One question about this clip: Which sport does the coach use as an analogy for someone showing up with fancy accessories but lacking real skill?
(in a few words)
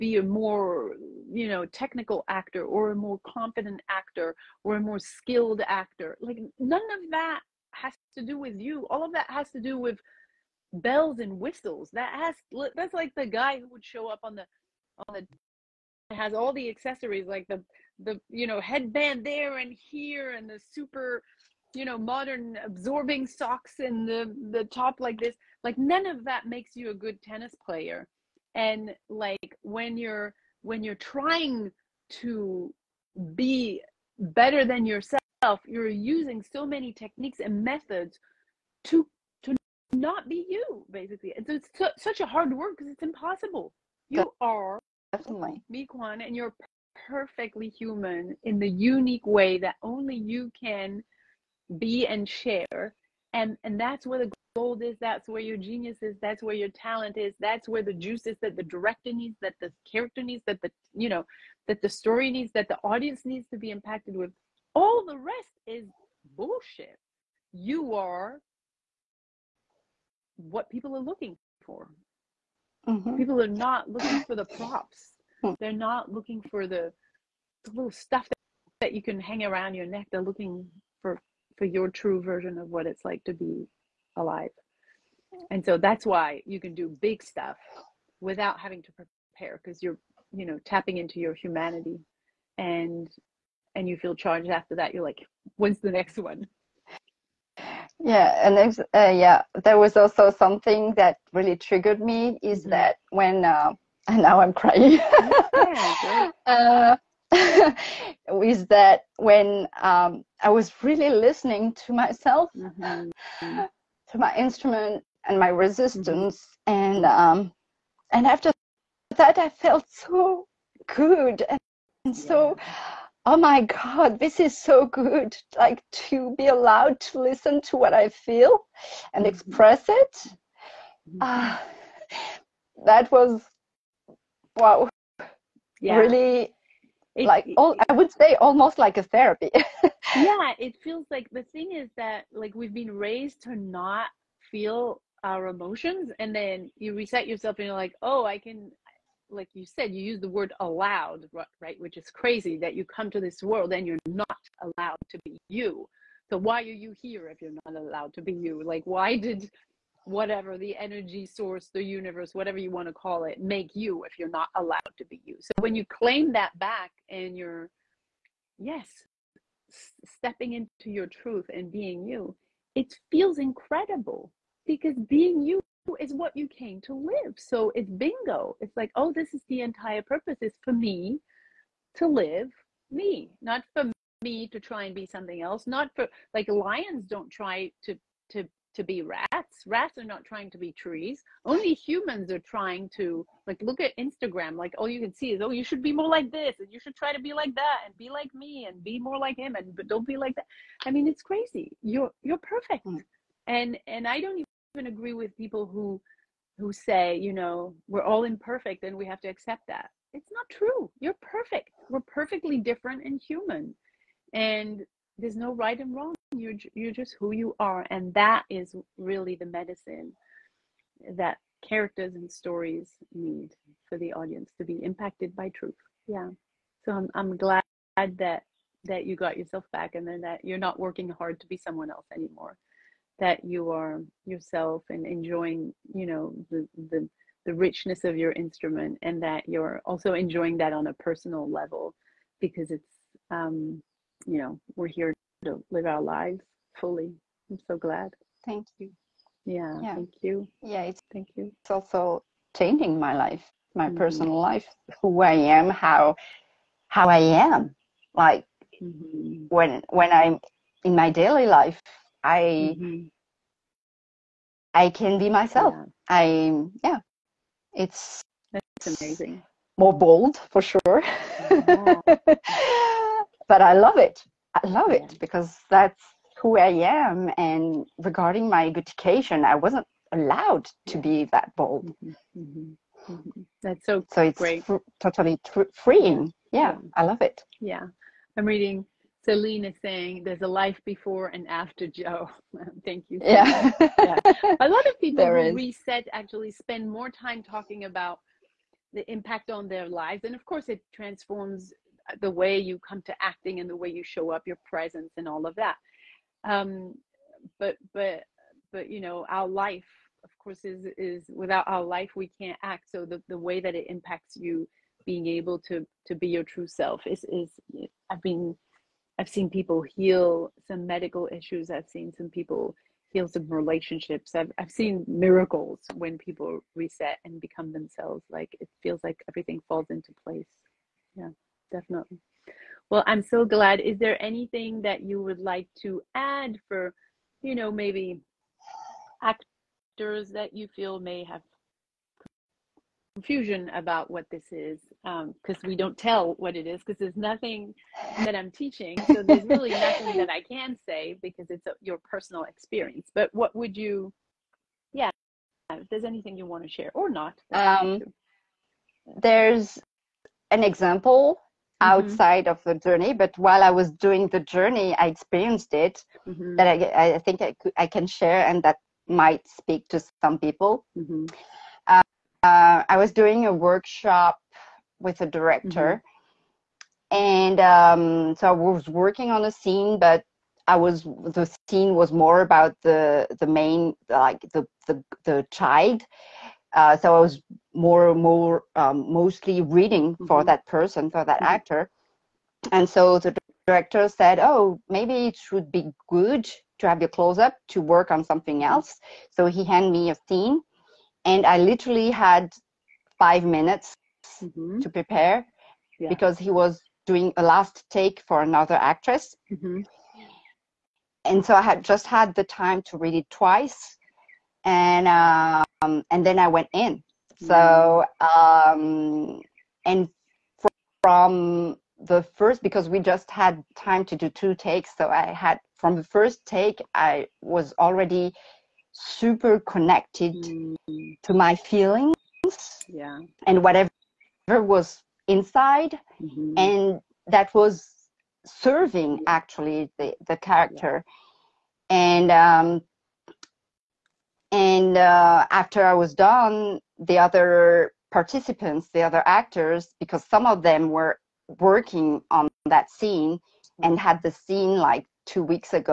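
Tennis.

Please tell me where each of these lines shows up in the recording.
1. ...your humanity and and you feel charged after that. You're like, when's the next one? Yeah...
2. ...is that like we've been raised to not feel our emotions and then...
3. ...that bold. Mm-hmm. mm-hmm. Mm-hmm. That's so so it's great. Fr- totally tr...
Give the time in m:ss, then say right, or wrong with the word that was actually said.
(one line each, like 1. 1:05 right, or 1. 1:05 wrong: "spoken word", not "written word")
1. 1:31 right
2. 2:21 right
3. 4:41 right.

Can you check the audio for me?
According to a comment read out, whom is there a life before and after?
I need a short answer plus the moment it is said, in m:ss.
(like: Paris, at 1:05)
Jo, at 4:51.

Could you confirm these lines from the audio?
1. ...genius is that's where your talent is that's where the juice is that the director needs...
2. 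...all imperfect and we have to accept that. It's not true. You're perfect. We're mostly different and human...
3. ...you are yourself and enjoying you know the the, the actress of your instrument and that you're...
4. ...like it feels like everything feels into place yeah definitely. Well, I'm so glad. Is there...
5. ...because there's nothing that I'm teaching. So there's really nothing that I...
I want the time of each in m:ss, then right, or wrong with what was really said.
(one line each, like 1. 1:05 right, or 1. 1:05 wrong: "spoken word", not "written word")
1. 0:55 right
2. 3:28 wrong: "perfectly", not "mostly"
3. 3:53 wrong: "richness", not "actress"
4. 5:28 wrong: "falls", not "feels"
5. 5:46 right.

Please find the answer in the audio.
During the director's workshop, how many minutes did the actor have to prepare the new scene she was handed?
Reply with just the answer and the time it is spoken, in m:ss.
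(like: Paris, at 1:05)
5, at 6:43.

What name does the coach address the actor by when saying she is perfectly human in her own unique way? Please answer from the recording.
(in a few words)
Mi Kwan.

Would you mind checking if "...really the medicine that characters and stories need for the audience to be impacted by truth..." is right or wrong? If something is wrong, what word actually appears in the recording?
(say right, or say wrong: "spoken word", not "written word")
right.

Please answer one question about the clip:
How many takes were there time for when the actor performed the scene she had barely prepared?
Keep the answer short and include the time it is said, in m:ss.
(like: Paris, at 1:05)
2, at 7:04.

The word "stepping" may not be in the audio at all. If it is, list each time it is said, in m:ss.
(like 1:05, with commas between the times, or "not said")
2:50.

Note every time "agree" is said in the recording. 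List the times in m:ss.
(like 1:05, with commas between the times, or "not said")
3:24.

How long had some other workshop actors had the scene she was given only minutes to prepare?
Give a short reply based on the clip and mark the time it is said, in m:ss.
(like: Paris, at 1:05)
2 weeks, at 7:35.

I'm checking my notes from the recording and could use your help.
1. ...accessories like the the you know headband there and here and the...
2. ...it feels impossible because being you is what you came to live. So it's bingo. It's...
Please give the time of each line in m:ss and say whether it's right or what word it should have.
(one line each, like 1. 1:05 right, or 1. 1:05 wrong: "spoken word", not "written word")
1. 0:16 right
2. 2:52 wrong: "incredible", not "impossible".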